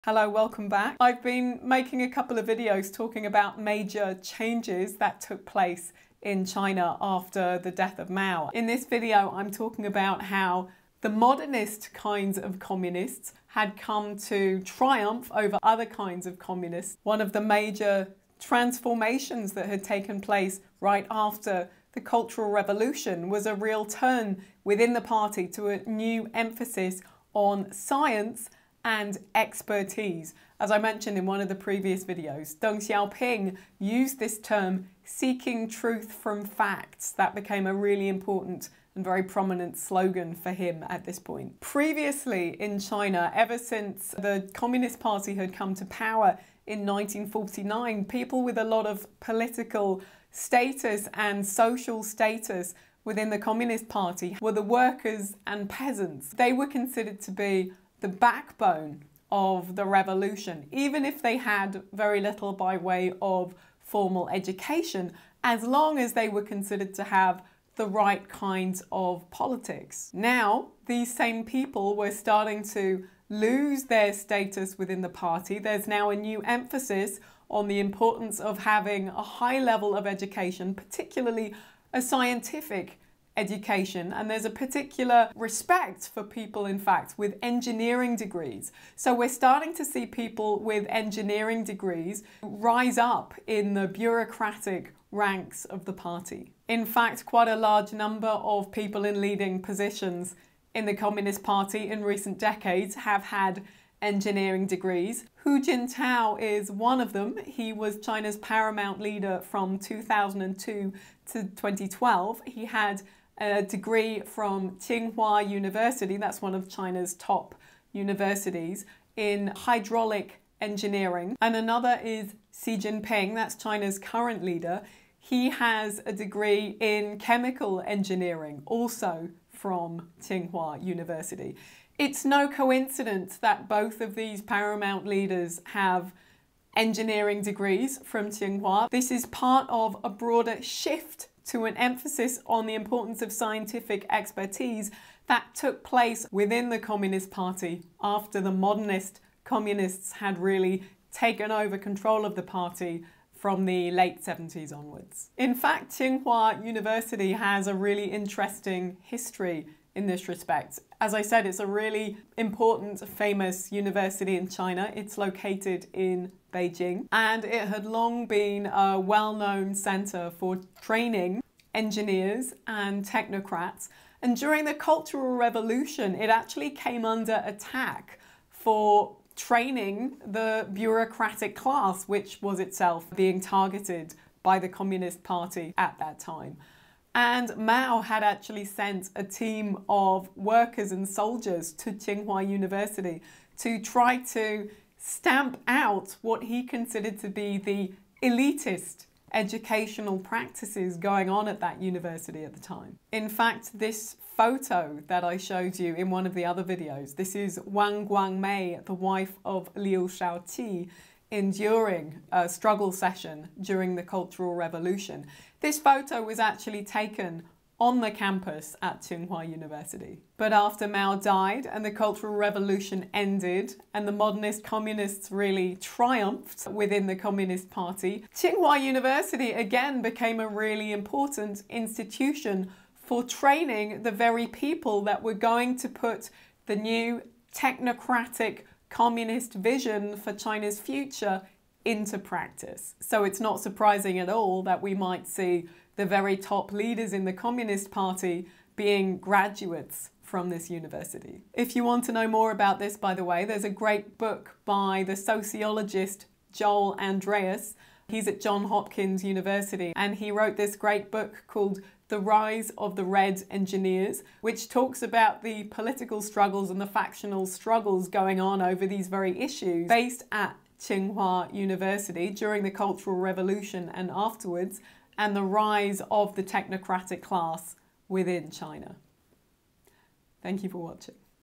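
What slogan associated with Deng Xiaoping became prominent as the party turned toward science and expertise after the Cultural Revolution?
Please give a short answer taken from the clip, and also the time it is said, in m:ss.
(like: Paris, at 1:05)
Seeking truth from facts, at 0:35.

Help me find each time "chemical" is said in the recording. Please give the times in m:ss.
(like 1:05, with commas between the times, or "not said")
2:07.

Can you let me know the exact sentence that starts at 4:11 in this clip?
If you want to know more about this, by the way, there's a great book by the sociologist Joel Andreas.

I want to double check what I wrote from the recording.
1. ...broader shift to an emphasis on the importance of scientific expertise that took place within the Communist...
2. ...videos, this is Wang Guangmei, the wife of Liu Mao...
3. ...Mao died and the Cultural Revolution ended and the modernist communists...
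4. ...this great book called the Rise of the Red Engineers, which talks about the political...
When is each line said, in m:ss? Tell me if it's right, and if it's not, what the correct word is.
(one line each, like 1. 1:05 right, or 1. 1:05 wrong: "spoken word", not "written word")
1. 2:20 right
2. 3:26 wrong: "Shaoqi", not "Mao"
3. 3:40 right
4. 4:20 right.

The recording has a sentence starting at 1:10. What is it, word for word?
Now, these same people were starting to lose their status within the party.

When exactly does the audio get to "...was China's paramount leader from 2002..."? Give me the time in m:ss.
1:47.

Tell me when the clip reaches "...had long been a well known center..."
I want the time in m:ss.
2:47.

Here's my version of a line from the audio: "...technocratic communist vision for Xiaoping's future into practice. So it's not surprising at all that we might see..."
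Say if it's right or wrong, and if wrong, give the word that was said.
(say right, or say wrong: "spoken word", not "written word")
wrong: "China", not "Xiaoping".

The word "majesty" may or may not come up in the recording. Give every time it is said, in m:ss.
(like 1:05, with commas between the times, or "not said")
not said.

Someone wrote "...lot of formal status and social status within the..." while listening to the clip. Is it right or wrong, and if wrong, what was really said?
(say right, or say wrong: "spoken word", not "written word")
wrong: "political", not "formal".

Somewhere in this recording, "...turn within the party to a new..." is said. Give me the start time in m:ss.
0:23.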